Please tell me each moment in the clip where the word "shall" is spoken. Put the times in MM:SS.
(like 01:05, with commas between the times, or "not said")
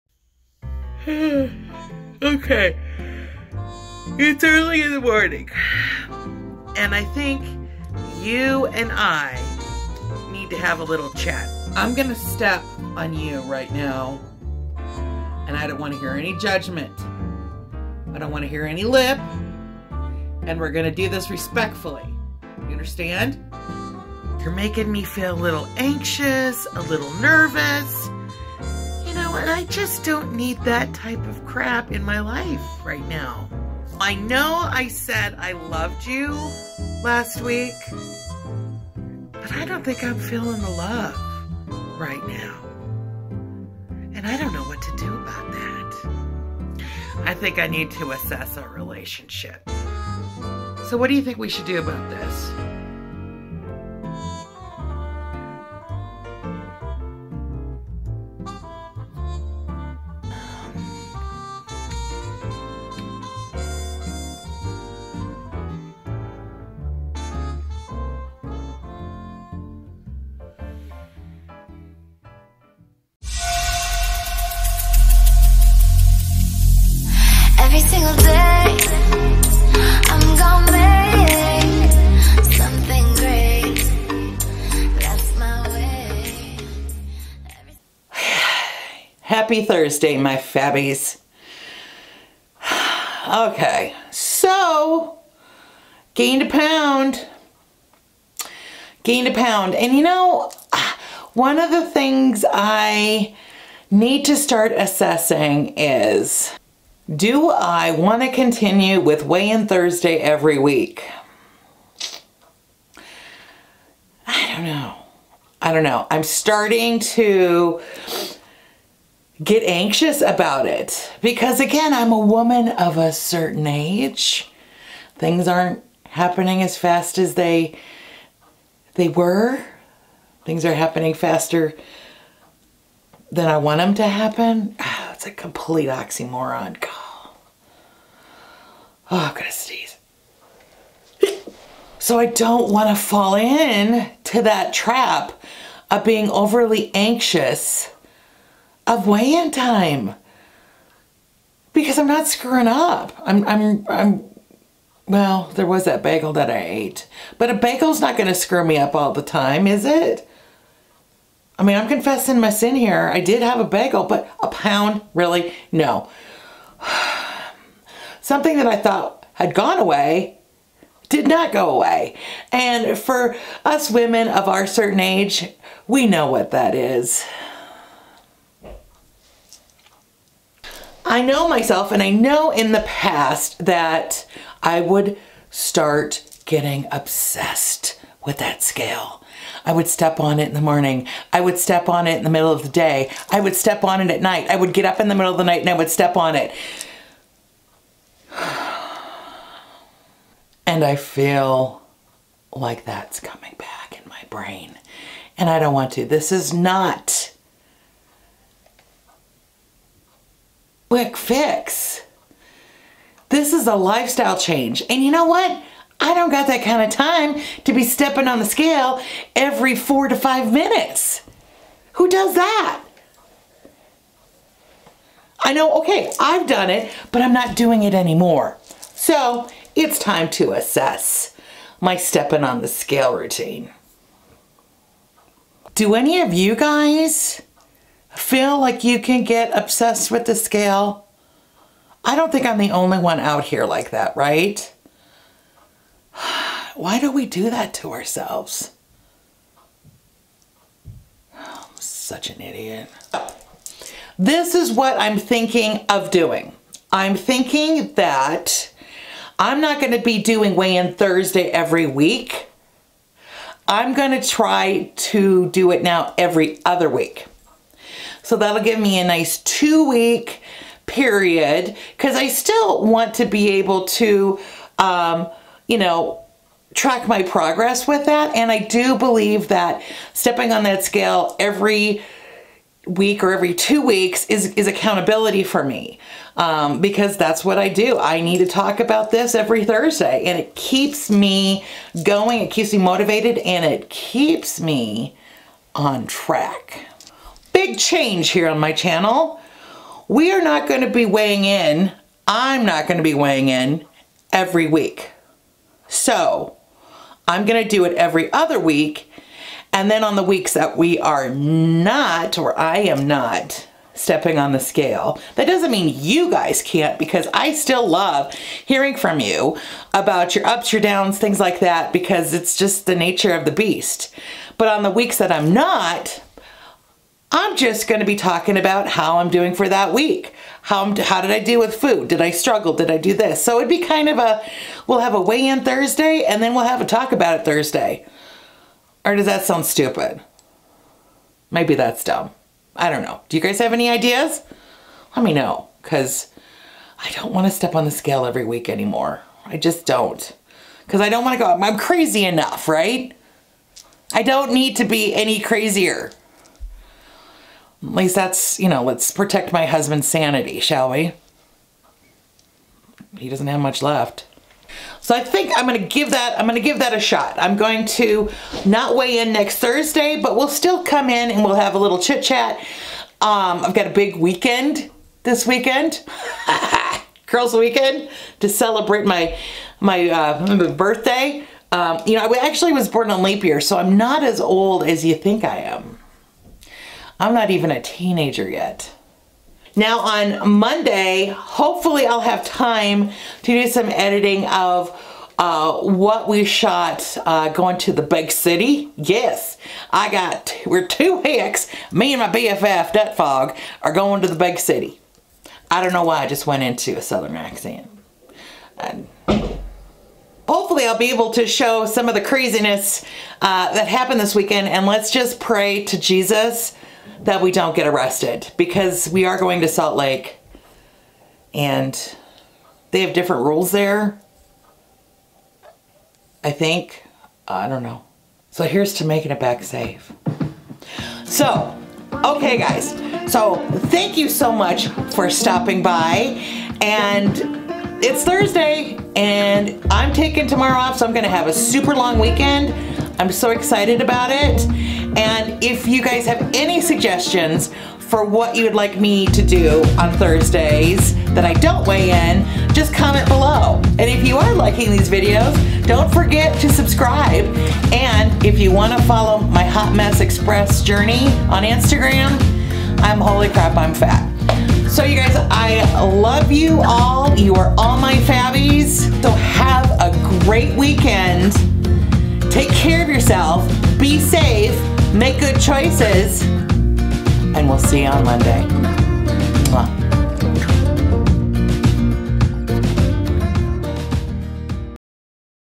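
06:00.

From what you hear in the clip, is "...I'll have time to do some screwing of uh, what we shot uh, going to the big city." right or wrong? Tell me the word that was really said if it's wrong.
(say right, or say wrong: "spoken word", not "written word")
wrong: "editing", not "screwing".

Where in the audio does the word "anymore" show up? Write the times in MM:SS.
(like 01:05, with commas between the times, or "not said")
03:47, 05:48.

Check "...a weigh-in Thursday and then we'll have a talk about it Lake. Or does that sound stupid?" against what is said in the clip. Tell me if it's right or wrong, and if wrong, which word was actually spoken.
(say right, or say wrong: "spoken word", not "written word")
wrong: "Thursday", not "Lake".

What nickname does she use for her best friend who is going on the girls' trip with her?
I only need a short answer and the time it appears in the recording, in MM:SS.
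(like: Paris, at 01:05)
Dutfog, at 06:42.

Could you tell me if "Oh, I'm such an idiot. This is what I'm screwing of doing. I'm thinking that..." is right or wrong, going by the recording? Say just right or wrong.
wrong.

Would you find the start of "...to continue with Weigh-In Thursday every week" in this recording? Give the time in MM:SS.
01:48.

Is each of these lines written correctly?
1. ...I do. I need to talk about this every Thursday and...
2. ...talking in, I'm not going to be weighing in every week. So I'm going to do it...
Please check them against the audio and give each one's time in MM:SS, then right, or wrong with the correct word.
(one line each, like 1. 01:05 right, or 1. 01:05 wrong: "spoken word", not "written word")
1. 04:47 right
2. 05:01 wrong: "weighing", not "talking".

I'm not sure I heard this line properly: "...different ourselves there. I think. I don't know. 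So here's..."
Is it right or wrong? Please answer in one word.
wrong.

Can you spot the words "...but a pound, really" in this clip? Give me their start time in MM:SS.
02:44.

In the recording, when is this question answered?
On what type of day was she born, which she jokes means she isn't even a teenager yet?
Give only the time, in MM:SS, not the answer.
06:22.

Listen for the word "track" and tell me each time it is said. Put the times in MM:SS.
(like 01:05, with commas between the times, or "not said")
04:36, 04:56.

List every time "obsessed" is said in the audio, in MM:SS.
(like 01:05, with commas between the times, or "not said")
03:06, 03:59.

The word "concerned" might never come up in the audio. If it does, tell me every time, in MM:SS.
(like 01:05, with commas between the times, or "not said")
not said.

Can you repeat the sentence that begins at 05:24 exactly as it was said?
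But on the weeks that I'm not, I'm just going to be talking about how I'm doing for that week.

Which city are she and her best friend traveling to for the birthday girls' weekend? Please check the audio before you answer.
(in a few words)
Salt Lake.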